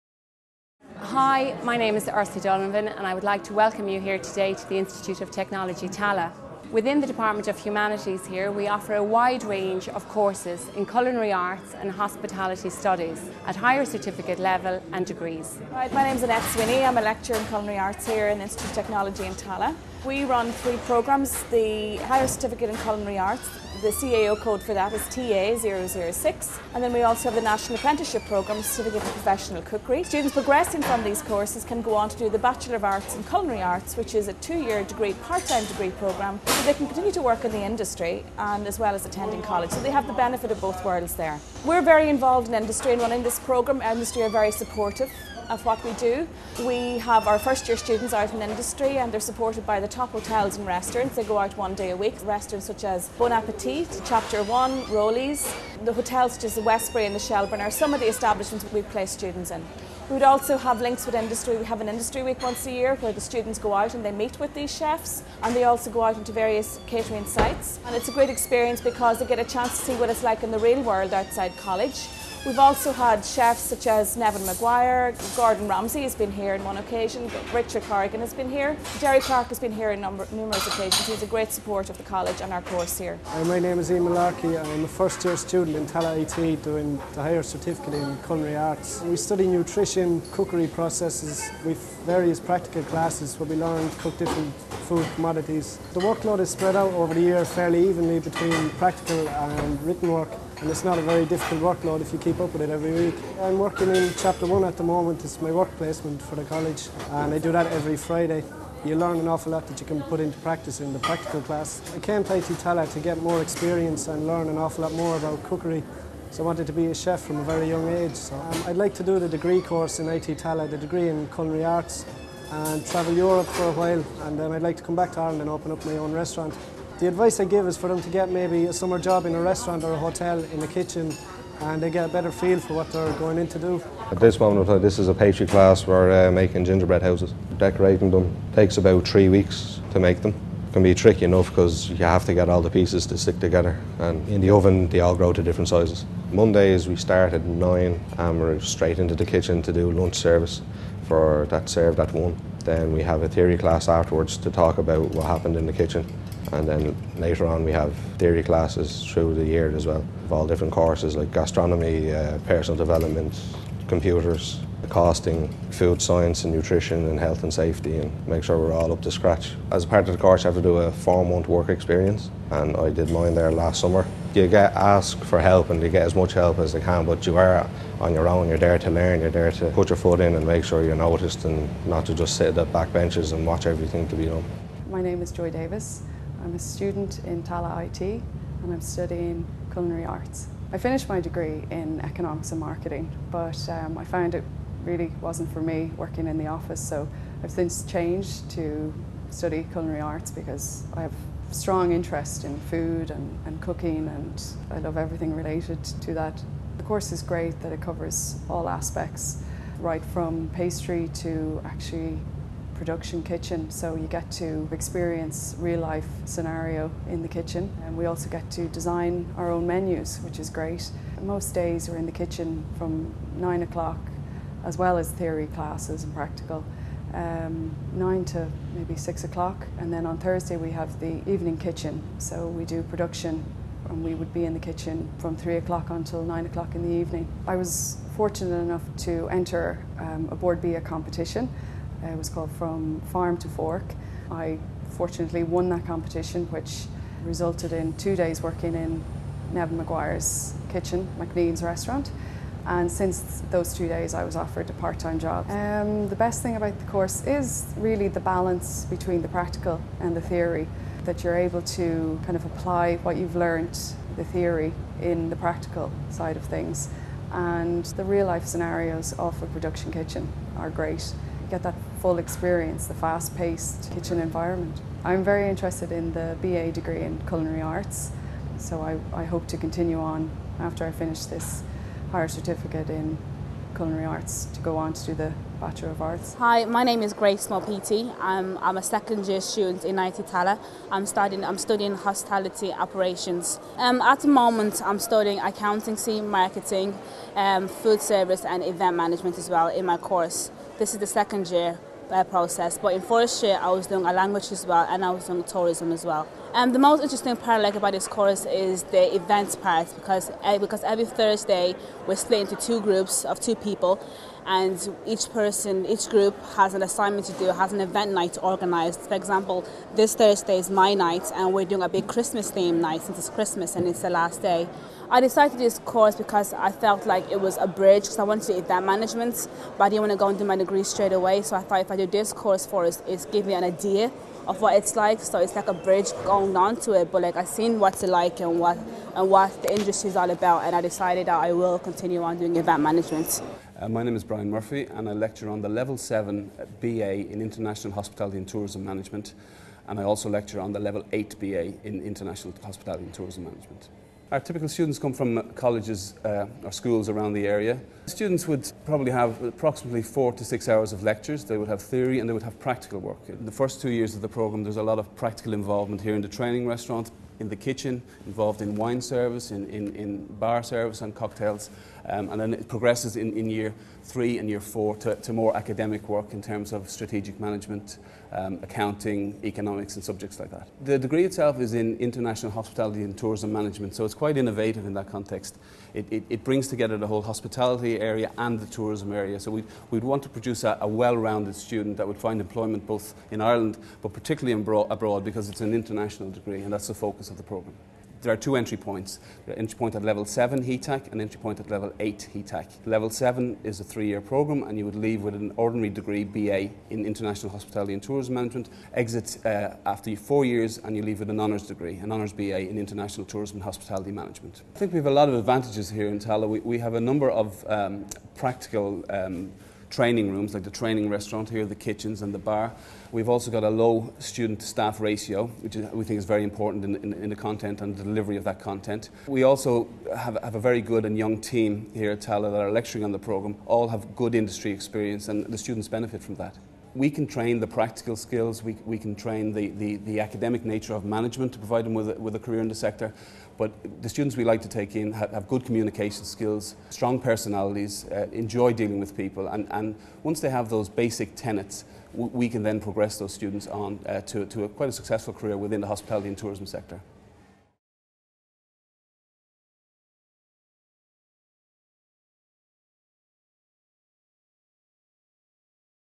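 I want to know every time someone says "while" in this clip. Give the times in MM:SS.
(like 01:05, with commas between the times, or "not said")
02:03.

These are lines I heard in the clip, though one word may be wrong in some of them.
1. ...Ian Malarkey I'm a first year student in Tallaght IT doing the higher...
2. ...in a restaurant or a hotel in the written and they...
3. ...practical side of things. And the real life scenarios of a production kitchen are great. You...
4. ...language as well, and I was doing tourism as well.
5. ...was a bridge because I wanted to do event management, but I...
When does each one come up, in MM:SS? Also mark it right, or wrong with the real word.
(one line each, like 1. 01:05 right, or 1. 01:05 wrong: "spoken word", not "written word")
1. 01:23 right
2. 02:09 wrong: "kitchen", not "written"
3. 04:25 right
4. 05:04 right
5. 05:27 right.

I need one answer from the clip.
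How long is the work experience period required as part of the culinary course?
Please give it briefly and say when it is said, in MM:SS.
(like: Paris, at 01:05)
4 months, at 02:50.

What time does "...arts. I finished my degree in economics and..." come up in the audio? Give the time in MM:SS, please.
03:10.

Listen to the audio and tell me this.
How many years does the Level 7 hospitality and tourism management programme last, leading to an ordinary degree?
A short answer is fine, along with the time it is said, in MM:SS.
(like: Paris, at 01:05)
3, at 06:43.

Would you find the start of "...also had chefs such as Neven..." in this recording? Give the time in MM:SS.
01:12.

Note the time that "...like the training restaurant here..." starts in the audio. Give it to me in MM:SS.
07:00.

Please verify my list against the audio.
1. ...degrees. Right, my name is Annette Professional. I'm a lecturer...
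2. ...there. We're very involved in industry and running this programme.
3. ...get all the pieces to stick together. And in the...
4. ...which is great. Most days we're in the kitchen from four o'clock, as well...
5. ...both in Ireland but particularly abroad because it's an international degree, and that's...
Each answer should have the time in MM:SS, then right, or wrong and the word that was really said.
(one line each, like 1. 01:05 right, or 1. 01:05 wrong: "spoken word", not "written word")
1. 00:15 wrong: "Swinney", not "Professional"
2. 00:41 right
3. 02:22 right
4. 03:40 wrong: "nine", not "four"
5. 06:32 right.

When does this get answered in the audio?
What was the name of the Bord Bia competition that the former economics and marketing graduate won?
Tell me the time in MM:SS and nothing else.
04:02.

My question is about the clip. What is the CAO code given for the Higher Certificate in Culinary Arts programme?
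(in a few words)
TA006.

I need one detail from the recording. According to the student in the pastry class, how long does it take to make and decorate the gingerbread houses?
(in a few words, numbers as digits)
3 weeks.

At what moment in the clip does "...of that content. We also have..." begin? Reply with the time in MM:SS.
07:08.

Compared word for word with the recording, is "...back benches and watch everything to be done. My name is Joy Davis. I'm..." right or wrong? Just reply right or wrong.
right.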